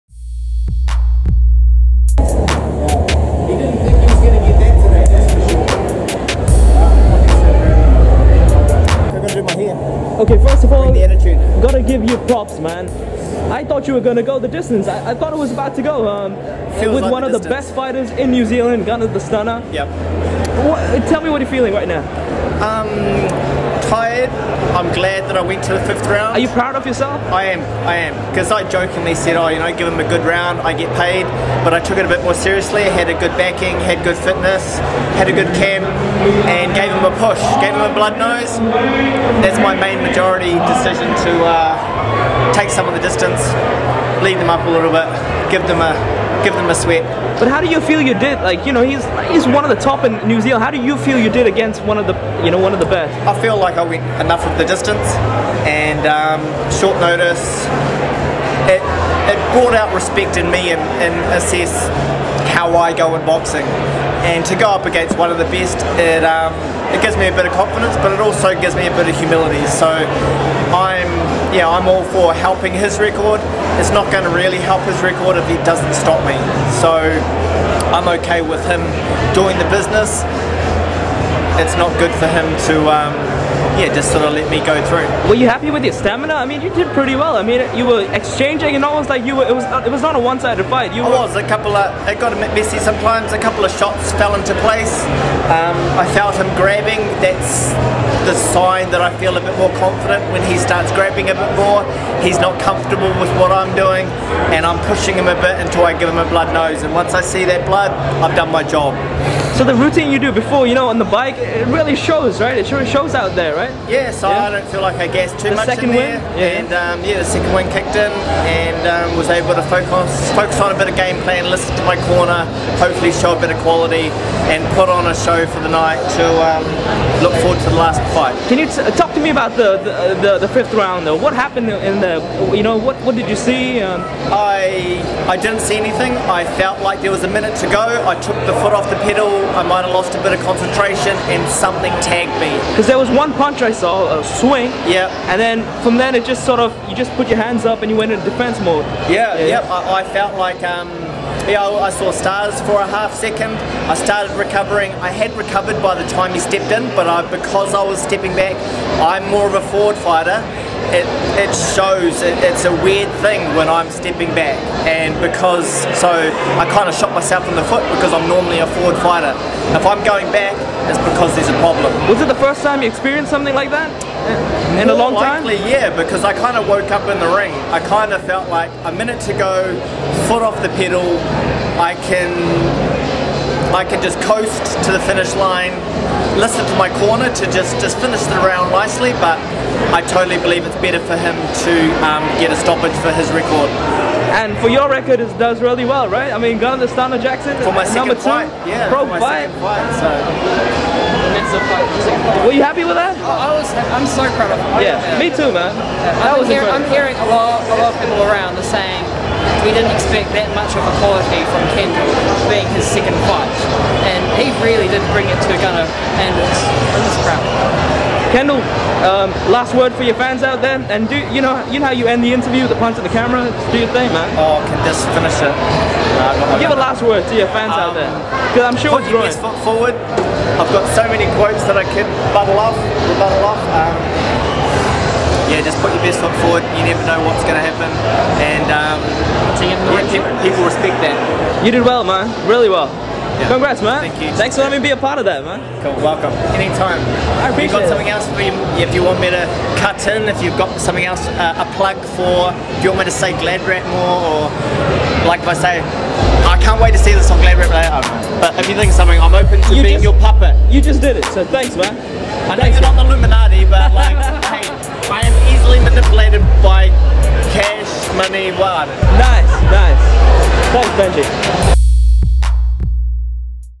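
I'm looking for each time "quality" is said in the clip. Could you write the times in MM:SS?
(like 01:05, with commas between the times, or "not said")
02:03, 03:30.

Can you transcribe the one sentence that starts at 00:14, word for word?
I, I thought it was about to go.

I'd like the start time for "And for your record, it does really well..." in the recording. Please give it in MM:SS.
03:14.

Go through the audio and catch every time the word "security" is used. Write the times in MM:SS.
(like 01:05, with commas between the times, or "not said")
not said.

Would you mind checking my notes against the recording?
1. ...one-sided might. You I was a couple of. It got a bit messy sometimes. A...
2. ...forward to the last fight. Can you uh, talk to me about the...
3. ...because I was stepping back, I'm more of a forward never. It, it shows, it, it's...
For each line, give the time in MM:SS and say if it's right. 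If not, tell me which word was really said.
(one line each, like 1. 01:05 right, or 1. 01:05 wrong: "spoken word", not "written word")
1. 01:30 wrong: "fight", not "might"
2. 02:07 right
3. 02:37 wrong: "fighter", not "never".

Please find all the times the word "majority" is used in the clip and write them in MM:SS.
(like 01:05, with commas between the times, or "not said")
00:40.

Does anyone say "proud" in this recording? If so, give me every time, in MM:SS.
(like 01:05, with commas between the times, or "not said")
00:26, 03:24, 03:37.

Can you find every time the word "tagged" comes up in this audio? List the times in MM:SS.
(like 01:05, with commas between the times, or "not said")
02:22.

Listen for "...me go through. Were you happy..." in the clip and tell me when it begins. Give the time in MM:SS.
01:24.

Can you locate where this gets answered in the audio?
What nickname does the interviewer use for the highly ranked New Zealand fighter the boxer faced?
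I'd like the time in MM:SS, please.
00:18.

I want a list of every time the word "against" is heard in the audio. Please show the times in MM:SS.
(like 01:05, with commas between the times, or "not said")
00:51, 01:04.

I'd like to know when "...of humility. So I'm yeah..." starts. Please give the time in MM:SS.
01:09.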